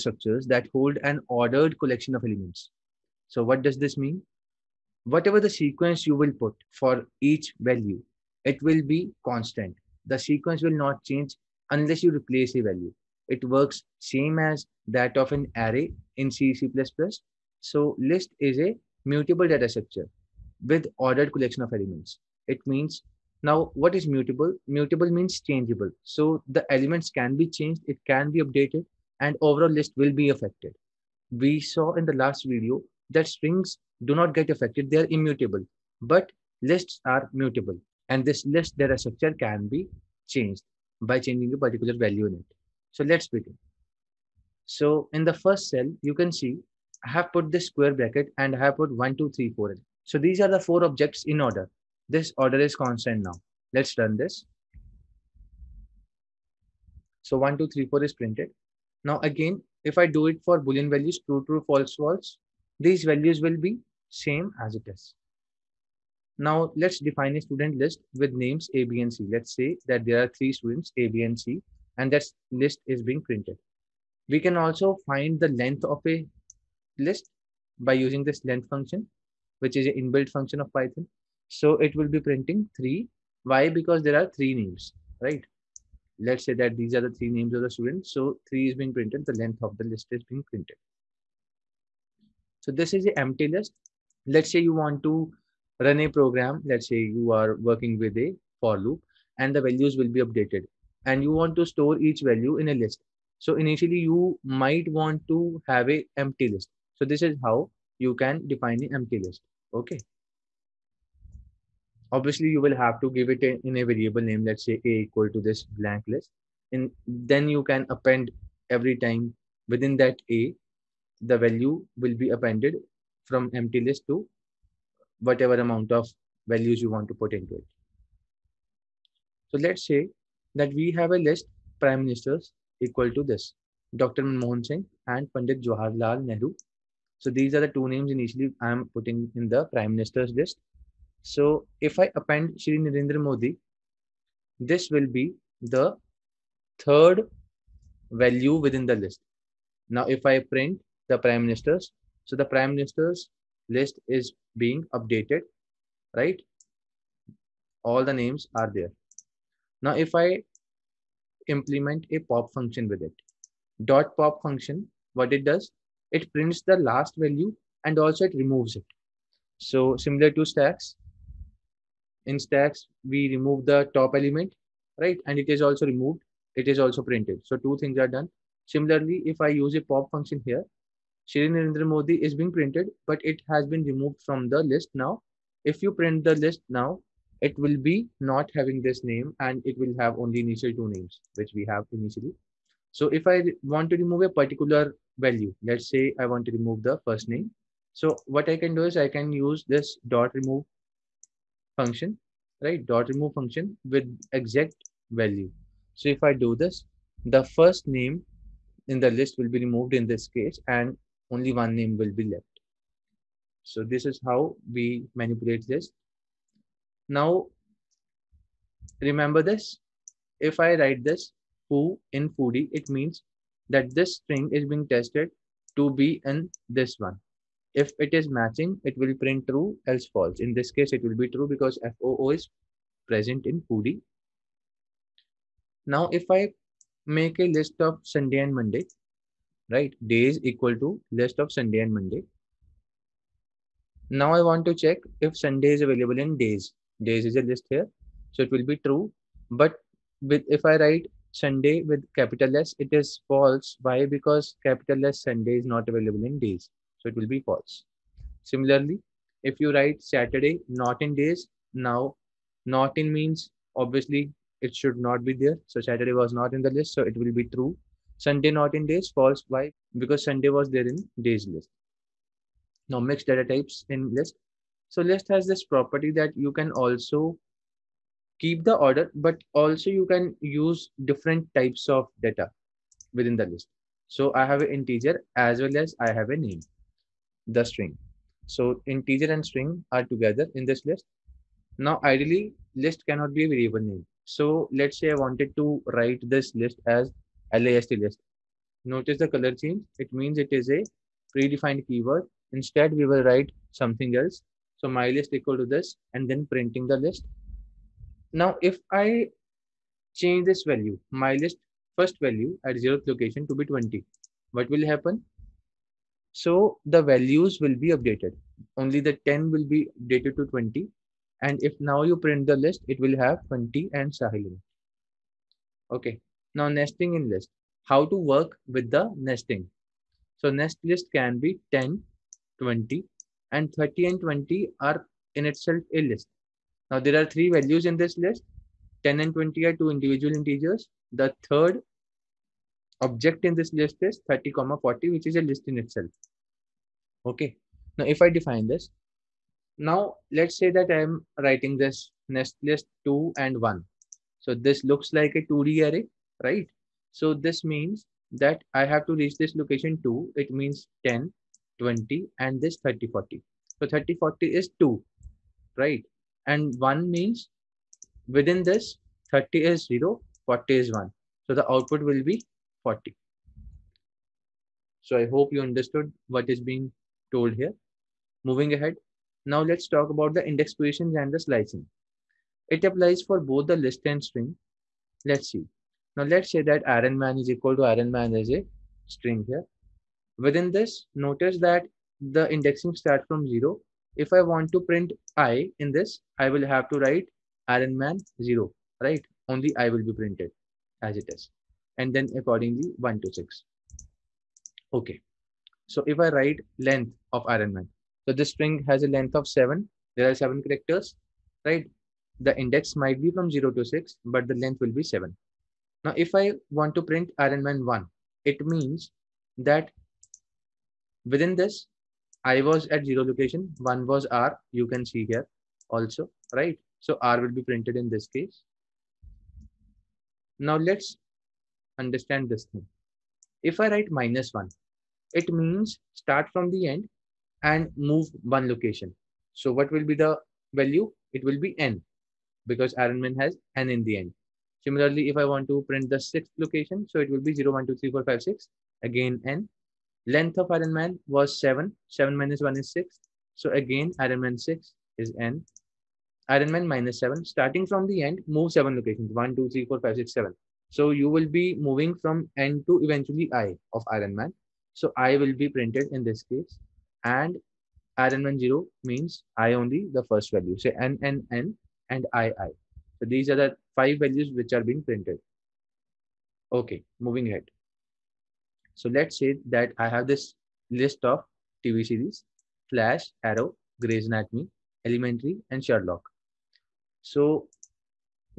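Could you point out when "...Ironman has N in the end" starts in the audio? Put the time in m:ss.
7:22.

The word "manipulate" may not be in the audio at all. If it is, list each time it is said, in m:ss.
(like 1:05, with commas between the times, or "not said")
3:35.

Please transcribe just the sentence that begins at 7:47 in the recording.
And Iron Man 0 means I only the first value.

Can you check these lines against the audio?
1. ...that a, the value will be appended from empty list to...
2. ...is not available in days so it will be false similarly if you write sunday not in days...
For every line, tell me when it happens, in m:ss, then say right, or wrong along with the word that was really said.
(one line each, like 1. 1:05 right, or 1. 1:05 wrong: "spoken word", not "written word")
1. 1:59 right
2. 4:15 wrong: "saturday", not "sunday".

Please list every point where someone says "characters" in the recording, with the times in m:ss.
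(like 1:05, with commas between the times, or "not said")
6:50.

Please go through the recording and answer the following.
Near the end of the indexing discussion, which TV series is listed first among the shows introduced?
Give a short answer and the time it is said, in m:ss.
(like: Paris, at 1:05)
Flash, at 8:02.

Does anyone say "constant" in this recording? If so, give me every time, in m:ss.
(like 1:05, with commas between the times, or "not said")
0:09, 0:52.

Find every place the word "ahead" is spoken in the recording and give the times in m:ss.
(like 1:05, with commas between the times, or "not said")
6:18, 7:57.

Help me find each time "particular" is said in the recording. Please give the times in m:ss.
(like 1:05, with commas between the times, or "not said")
0:41, 3:14.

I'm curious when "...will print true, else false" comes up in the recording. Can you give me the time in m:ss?
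3:48.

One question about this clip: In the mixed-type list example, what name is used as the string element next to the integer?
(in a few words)
Sahil.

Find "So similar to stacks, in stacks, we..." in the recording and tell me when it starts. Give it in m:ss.
2:49.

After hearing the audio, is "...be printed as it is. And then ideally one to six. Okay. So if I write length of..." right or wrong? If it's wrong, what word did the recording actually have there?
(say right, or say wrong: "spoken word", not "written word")
wrong: "accordingly", not "ideally".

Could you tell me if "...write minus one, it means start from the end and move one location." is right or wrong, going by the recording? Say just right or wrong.
right.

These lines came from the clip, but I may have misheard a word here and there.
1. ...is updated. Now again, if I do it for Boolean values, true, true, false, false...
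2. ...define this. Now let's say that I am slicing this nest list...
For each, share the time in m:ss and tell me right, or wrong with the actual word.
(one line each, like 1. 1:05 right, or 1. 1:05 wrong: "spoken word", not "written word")
1. 0:58 wrong: "printed", not "updated"
2. 5:48 wrong: "writing", not "slicing".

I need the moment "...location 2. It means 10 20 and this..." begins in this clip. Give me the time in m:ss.
5:59.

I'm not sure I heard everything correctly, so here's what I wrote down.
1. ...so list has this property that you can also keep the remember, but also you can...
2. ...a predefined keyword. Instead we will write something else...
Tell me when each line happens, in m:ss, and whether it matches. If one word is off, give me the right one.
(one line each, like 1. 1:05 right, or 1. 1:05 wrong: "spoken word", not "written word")
1. 4:34 wrong: "order", not "remember"
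2. 5:00 right.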